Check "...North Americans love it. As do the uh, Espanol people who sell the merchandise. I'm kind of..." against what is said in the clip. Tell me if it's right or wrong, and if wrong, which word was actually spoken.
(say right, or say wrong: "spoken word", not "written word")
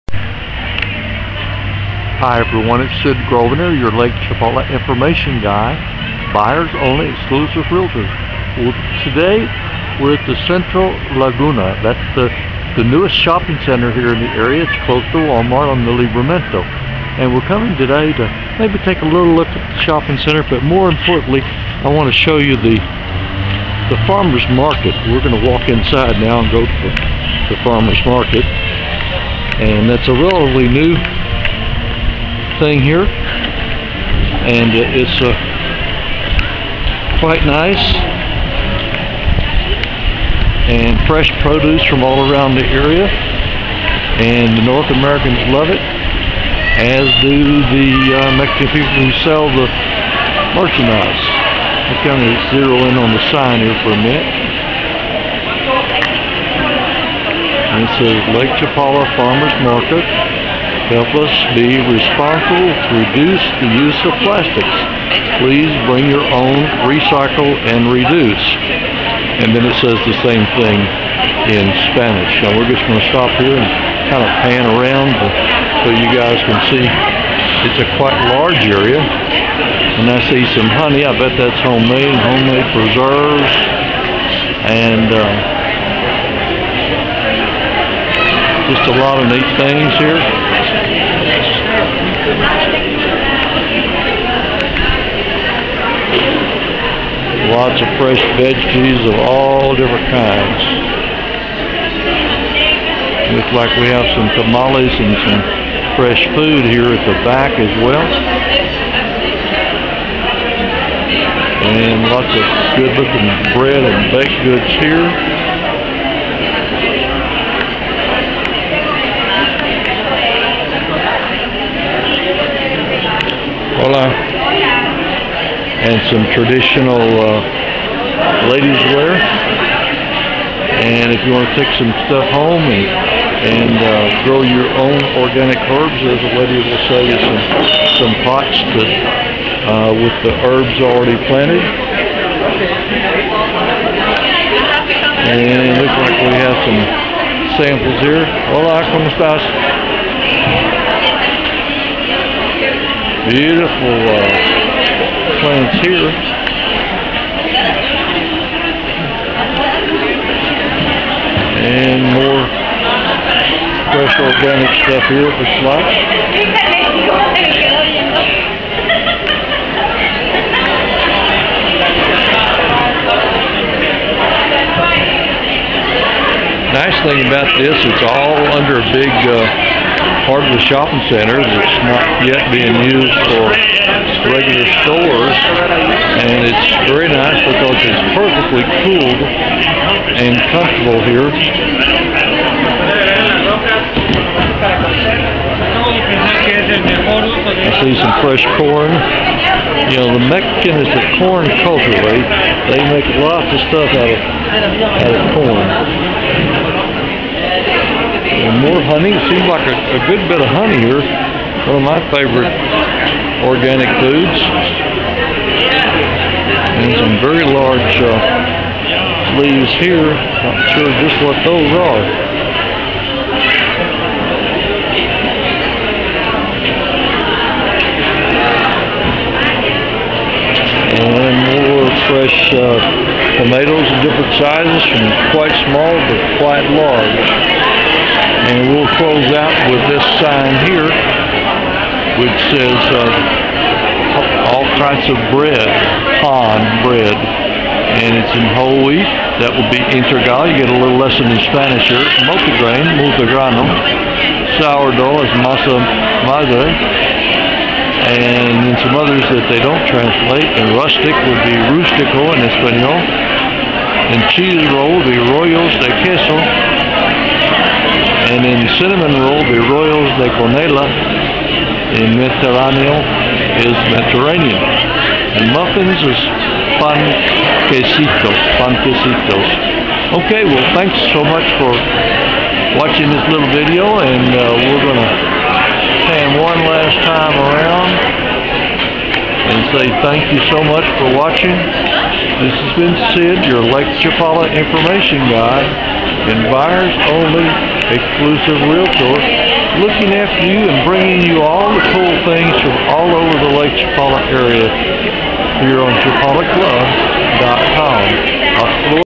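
wrong: "Mexican", not "Espanol".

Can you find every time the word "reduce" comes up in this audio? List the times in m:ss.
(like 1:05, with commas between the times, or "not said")
1:02, 1:07.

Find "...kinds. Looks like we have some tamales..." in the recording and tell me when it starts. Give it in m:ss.
1:40.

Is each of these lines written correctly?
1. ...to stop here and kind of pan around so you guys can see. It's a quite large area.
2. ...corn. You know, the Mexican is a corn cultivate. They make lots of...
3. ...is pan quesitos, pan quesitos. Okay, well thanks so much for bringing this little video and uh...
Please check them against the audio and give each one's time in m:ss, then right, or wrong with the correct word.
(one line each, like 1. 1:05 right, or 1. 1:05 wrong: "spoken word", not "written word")
1. 1:12 right
2. 3:18 right
3. 4:36 wrong: "watching", not "bringing".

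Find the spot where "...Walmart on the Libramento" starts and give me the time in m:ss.
0:15.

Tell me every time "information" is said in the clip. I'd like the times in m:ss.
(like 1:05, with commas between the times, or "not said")
0:04, 4:54.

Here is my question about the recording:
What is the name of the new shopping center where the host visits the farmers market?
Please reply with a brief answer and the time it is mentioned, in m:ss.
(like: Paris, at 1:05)
Central Laguna, at 0:10.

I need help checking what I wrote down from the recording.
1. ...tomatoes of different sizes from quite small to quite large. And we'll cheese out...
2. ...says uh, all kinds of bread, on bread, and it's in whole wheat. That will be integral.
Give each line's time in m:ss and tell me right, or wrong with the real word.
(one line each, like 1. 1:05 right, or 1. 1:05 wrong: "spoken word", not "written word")
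1. 3:53 wrong: "close", not "cheese"
2. 4:02 right.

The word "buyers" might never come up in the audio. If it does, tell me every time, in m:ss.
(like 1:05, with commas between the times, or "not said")
0:06, 4:56.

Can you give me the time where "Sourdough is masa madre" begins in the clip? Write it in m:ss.
4:14.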